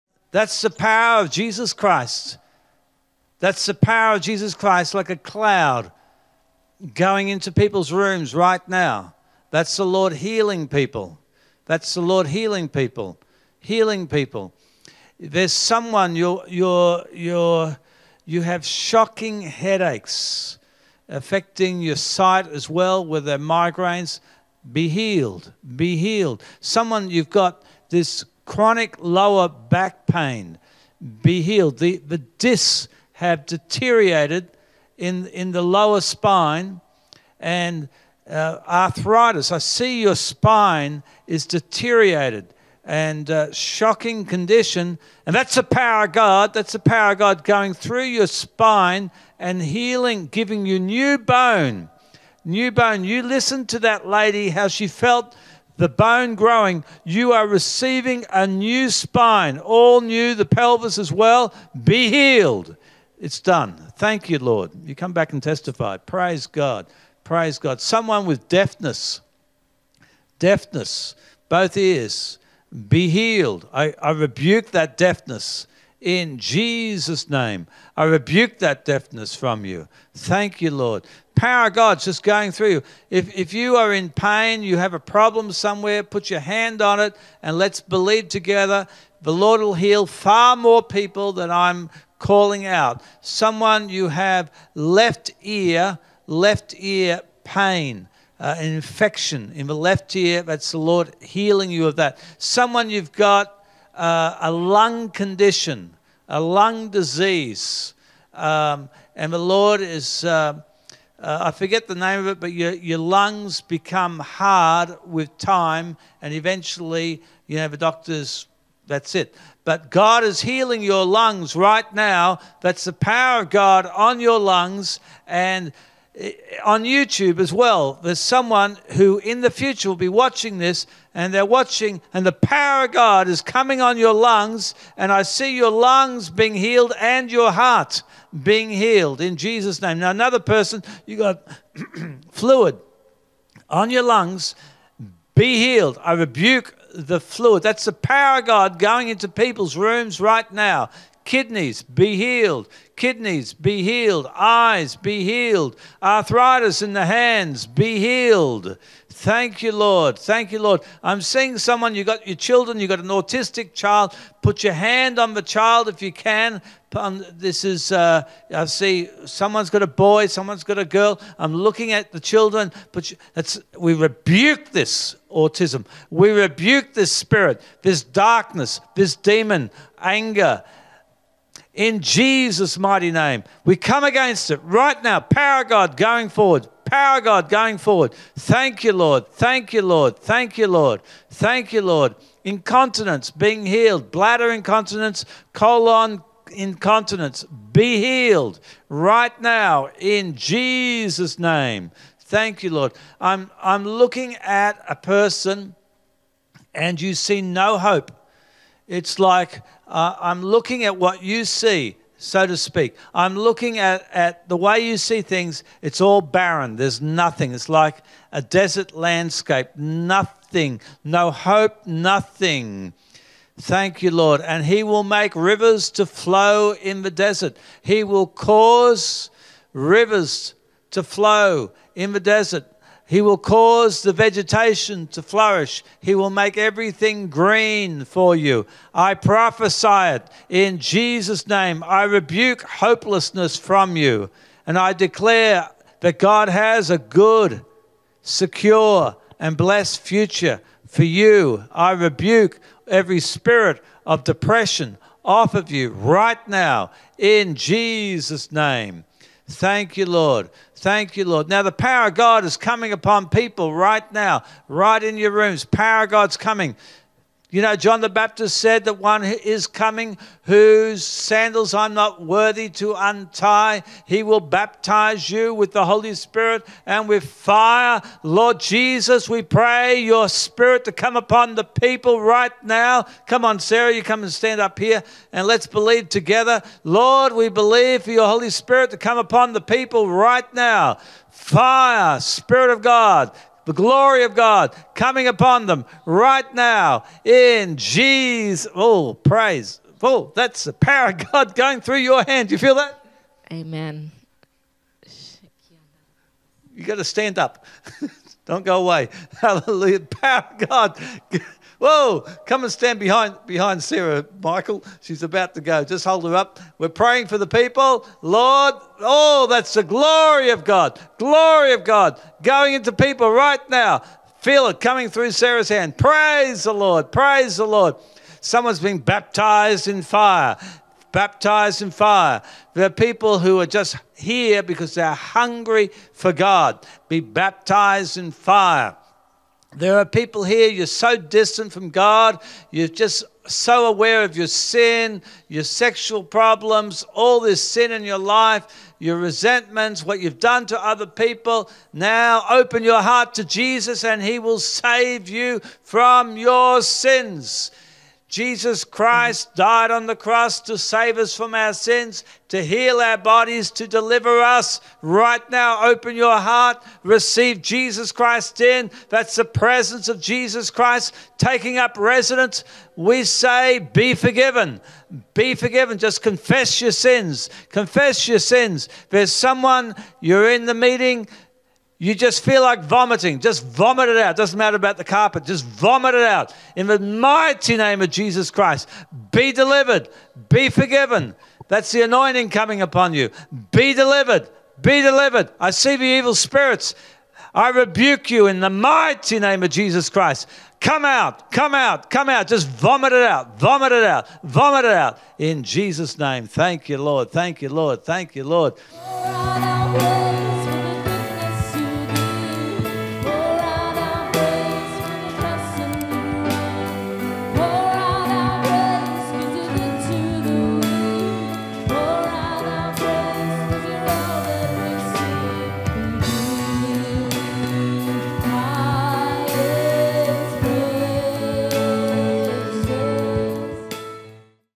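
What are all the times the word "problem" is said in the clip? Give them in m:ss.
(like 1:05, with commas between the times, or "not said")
1:24, 5:46.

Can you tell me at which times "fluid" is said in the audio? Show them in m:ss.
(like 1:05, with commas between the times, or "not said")
2:22, 2:27.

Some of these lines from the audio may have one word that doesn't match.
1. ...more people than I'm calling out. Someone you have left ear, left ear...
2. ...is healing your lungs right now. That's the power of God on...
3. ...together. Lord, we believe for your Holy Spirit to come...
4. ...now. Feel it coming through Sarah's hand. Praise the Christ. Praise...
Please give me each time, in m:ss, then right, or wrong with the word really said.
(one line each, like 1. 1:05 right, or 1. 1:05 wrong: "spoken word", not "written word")
1. 1:30 right
2. 2:00 right
3. 4:46 right
4. 5:23 wrong: "Lord", not "Christ".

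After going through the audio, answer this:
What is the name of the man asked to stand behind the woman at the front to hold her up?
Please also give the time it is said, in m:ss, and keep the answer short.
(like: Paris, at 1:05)
Michael, at 5:14.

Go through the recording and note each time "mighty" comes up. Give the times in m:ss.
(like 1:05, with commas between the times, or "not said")
3:02, 6:26, 6:38.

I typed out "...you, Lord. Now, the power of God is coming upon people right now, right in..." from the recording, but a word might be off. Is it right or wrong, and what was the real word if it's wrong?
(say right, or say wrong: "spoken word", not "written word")
right.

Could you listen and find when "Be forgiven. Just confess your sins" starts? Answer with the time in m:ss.
6:15.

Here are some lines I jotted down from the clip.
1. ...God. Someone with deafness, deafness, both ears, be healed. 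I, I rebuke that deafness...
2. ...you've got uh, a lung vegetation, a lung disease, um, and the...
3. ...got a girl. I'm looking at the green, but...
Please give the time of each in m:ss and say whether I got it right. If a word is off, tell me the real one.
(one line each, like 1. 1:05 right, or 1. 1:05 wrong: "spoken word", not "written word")
1. 1:07 right
2. 1:42 wrong: "condition", not "vegetation"
3. 2:50 wrong: "children", not "green".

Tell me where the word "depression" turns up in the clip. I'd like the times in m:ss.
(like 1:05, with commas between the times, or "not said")
4:14.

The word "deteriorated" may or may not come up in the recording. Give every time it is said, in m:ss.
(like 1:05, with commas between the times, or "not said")
0:33, 0:41.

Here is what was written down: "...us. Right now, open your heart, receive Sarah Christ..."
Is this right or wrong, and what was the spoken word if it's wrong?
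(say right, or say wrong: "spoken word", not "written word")
wrong: "Jesus", not "Sarah".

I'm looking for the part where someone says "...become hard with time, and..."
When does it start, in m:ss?
1:53.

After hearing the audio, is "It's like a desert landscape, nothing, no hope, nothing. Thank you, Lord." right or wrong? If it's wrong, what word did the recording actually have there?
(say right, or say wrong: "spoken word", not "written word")
right.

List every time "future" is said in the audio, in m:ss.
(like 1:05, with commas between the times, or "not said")
2:09, 4:09.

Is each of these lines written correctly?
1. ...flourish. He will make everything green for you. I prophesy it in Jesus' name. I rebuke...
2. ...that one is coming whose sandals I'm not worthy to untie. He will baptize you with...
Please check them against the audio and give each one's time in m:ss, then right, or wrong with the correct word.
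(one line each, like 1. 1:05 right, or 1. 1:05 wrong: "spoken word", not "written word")
1. 3:55 right
2. 4:28 right.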